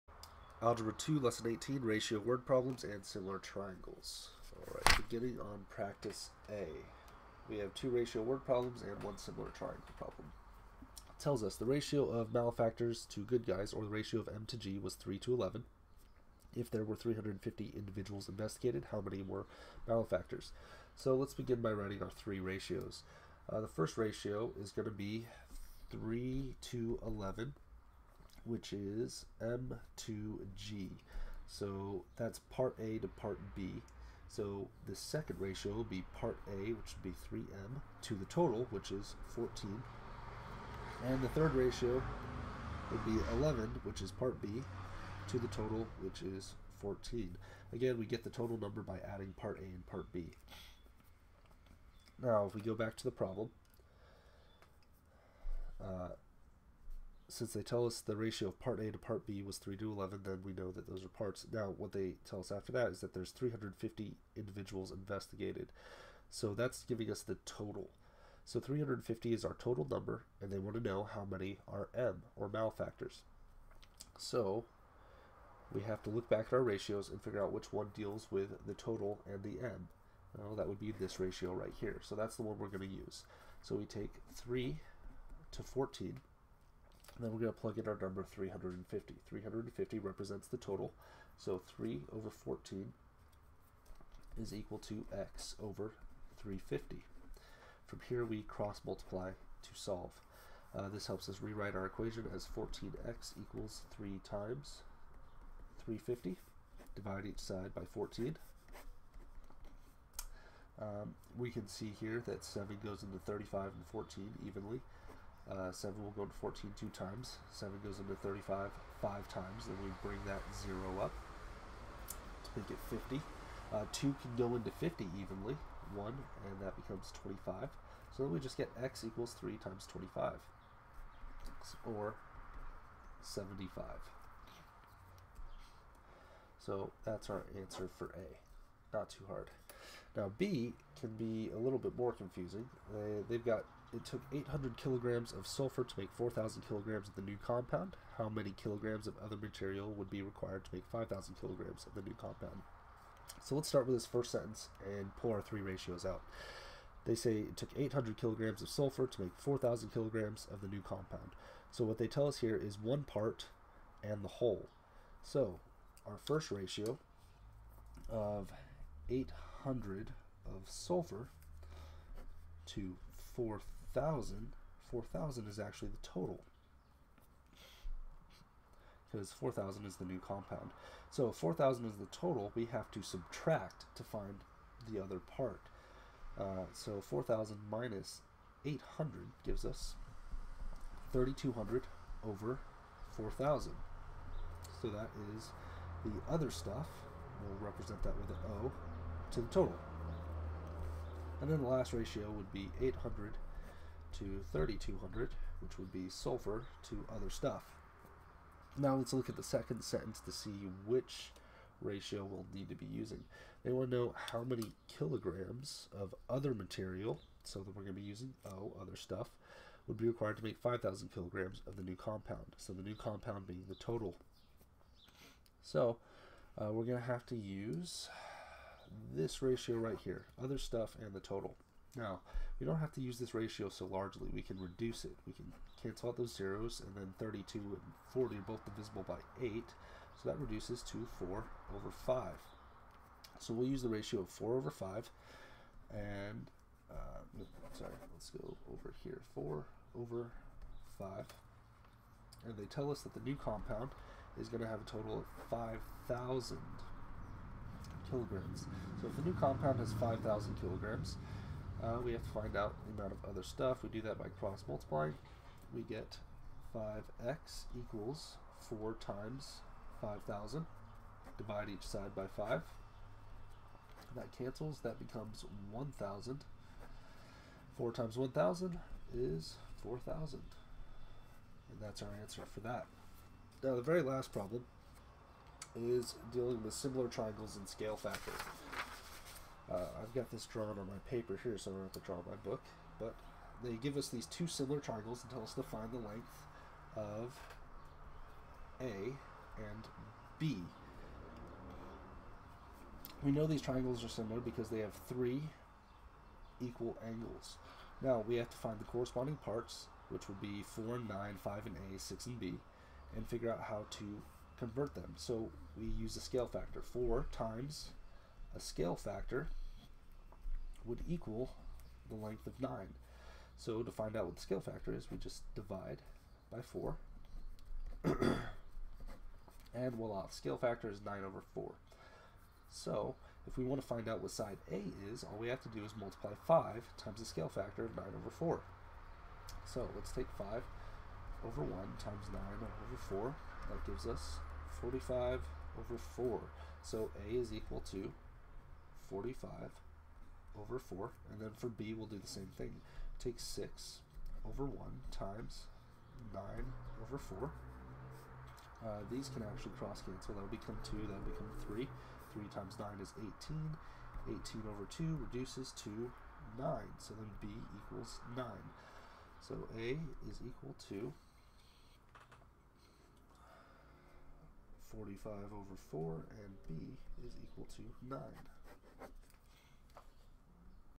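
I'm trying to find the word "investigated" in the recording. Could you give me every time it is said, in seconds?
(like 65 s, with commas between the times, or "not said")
18 s, 64 s.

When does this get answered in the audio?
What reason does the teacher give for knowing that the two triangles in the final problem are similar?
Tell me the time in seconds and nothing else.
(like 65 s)
305 s.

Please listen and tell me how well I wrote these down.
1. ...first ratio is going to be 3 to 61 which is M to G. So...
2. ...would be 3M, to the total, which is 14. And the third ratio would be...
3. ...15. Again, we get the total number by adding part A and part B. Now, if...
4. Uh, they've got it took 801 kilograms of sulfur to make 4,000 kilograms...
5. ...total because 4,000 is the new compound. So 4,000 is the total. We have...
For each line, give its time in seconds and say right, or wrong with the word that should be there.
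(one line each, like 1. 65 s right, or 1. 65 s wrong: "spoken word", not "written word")
1. 23 s wrong: "11", not "61"
2. 36 s right
3. 46 s wrong: "14", not "15"
4. 142 s wrong: "800", not "801"
5. 176 s right.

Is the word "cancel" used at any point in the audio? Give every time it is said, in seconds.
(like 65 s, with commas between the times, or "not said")
235 s, 274 s, 360 s.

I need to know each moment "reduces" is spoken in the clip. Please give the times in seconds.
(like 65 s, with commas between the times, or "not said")
234 s, 240 s, 365 s.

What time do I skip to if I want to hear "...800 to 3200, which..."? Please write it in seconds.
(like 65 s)
202 s.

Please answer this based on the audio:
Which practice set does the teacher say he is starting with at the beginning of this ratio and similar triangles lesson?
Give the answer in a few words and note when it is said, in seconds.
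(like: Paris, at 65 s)
Practice A, at 5 s.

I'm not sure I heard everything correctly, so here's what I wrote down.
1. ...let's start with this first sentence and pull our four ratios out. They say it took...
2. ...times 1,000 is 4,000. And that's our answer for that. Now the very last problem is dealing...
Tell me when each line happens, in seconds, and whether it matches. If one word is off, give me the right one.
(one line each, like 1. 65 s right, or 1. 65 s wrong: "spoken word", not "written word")
1. 153 s wrong: "three", not "four"
2. 277 s right.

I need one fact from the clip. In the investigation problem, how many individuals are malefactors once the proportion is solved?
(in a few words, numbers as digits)
75.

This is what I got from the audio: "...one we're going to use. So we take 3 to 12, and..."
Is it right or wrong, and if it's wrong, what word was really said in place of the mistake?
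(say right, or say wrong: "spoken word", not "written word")
wrong: "14", not "12".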